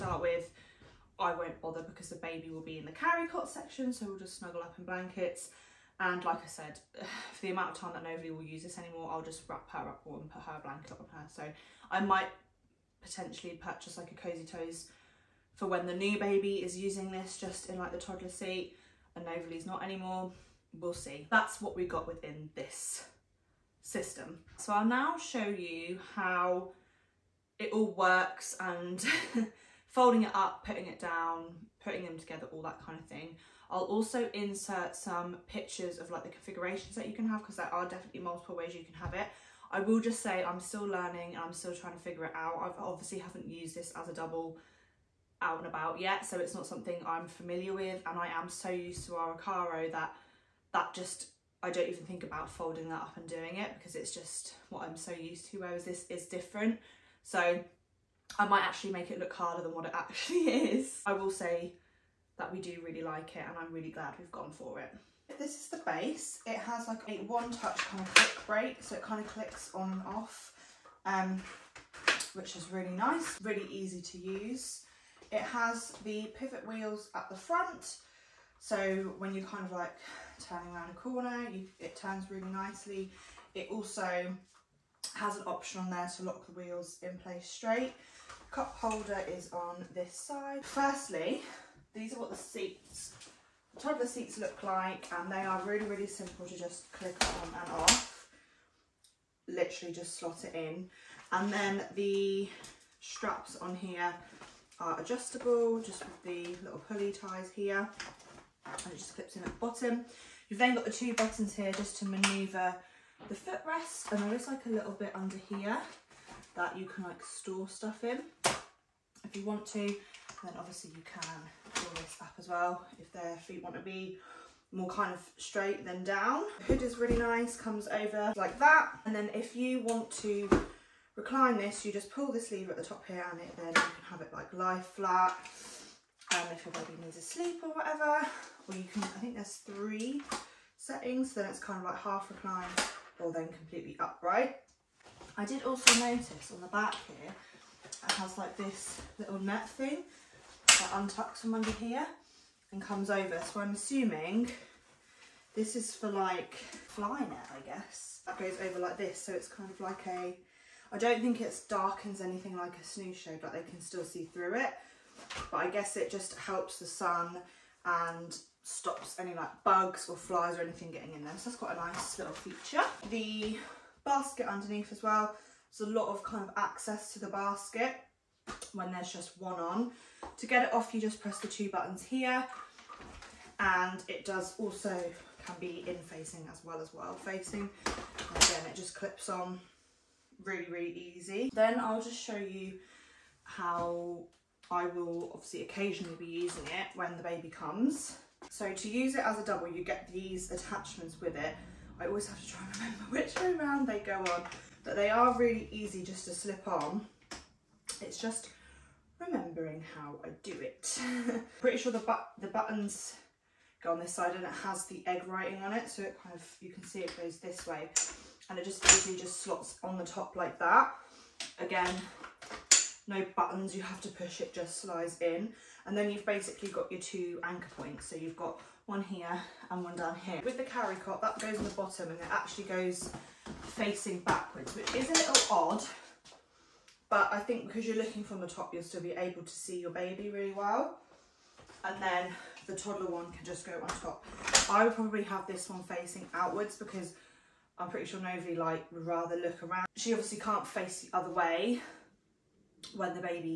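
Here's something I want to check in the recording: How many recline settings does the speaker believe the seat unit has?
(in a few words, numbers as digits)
3.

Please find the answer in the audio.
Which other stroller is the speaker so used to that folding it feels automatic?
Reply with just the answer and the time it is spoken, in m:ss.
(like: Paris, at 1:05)
Ocarro, at 0:49.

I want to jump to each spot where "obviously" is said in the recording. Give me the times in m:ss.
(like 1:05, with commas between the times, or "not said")
0:42, 2:00, 3:15, 4:10.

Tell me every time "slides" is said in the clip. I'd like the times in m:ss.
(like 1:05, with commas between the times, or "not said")
3:44.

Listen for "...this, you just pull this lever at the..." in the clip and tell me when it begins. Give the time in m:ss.
2:11.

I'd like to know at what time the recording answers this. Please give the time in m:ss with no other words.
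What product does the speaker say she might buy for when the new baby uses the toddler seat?
0:14.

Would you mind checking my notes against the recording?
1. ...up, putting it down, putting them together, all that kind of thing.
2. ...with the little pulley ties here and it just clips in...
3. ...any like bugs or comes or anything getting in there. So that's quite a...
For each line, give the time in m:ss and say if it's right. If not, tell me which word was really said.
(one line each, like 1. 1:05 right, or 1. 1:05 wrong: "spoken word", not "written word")
1. 0:30 right
2. 1:46 right
3. 2:49 wrong: "flies", not "comes".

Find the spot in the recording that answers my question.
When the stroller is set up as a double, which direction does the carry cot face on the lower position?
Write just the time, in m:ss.
3:54.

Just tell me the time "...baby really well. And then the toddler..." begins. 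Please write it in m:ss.
3:59.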